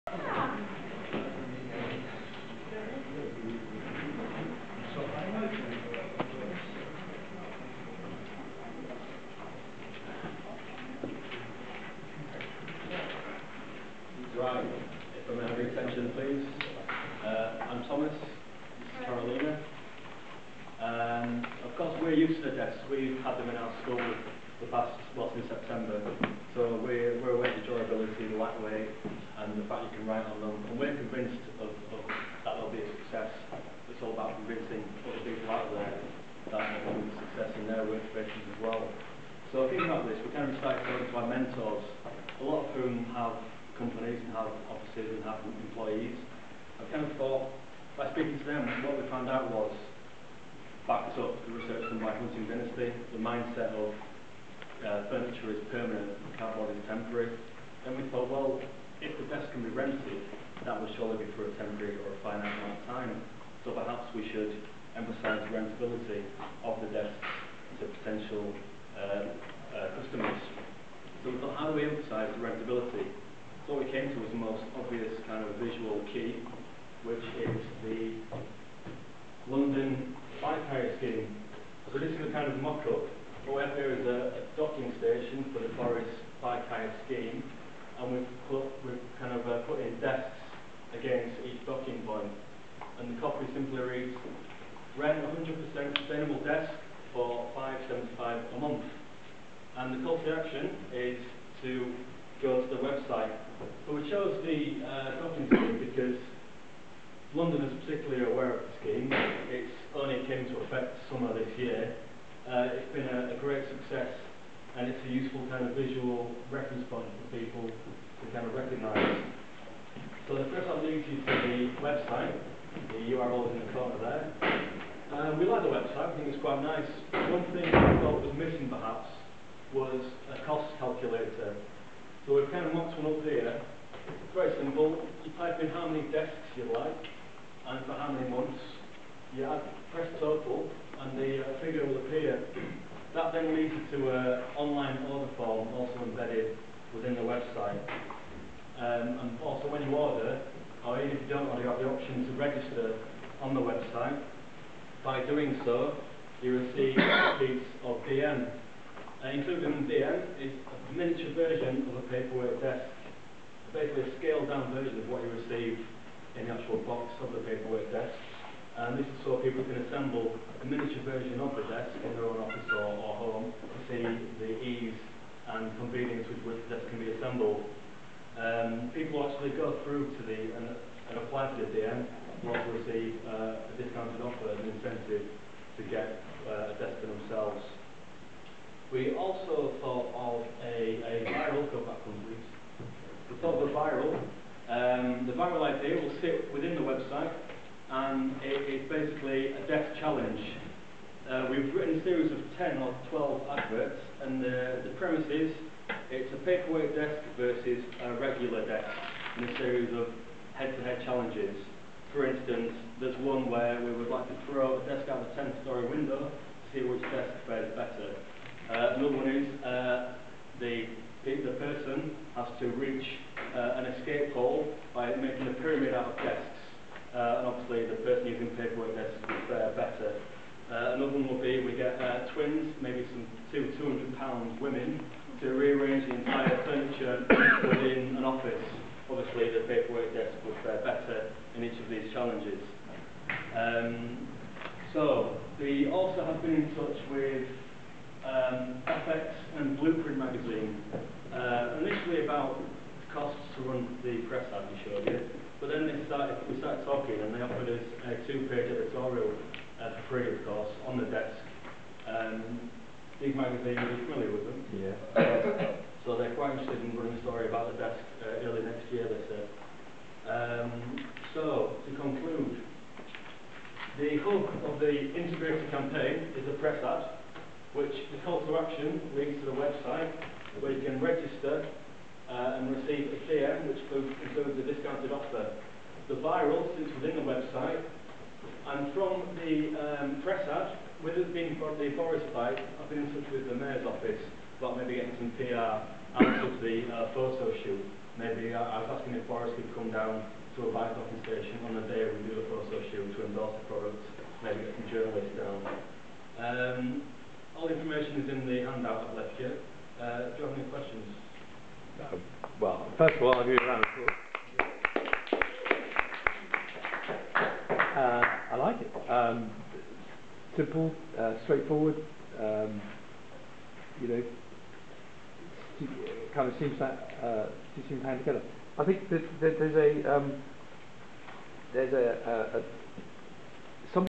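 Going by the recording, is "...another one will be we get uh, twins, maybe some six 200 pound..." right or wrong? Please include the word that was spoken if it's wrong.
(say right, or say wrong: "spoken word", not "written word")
wrong: "two", not "six".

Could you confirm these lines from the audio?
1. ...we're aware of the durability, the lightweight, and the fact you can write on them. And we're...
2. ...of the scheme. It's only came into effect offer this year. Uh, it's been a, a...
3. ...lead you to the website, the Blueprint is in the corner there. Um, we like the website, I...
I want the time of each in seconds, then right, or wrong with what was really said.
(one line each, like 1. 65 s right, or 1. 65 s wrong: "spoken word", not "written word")
1. 27 s right
2. 108 s wrong: "summer", not "offer"
3. 120 s wrong: "URL", not "Blueprint".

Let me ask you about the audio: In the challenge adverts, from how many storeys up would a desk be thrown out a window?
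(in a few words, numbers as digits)
10.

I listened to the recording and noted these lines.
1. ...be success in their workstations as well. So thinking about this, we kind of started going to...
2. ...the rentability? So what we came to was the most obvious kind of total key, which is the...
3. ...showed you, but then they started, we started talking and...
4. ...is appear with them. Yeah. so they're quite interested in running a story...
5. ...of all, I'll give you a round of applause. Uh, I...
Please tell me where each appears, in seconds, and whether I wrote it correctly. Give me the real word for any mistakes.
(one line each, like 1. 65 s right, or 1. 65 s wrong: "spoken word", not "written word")
1. 36 s right
2. 72 s wrong: "visual", not "total"
3. 254 s right
4. 263 s wrong: "familiar", not "appear"
5. 313 s right.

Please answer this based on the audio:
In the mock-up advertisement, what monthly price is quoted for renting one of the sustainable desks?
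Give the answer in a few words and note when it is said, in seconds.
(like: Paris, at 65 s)
5.75, at 97 s.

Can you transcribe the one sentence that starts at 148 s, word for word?
Um, and also when you order, or even if you don't order, you have the option to register on the website.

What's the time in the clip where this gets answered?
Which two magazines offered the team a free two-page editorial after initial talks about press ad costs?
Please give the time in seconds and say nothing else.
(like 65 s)
248 s.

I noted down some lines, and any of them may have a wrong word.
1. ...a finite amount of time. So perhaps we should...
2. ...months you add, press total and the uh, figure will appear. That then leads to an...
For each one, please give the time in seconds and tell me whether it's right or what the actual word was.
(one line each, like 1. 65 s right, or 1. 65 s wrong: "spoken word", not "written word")
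1. 62 s right
2. 138 s right.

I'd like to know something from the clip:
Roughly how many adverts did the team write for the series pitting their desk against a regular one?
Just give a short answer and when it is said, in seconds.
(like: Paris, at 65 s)
10 or 12, at 202 s.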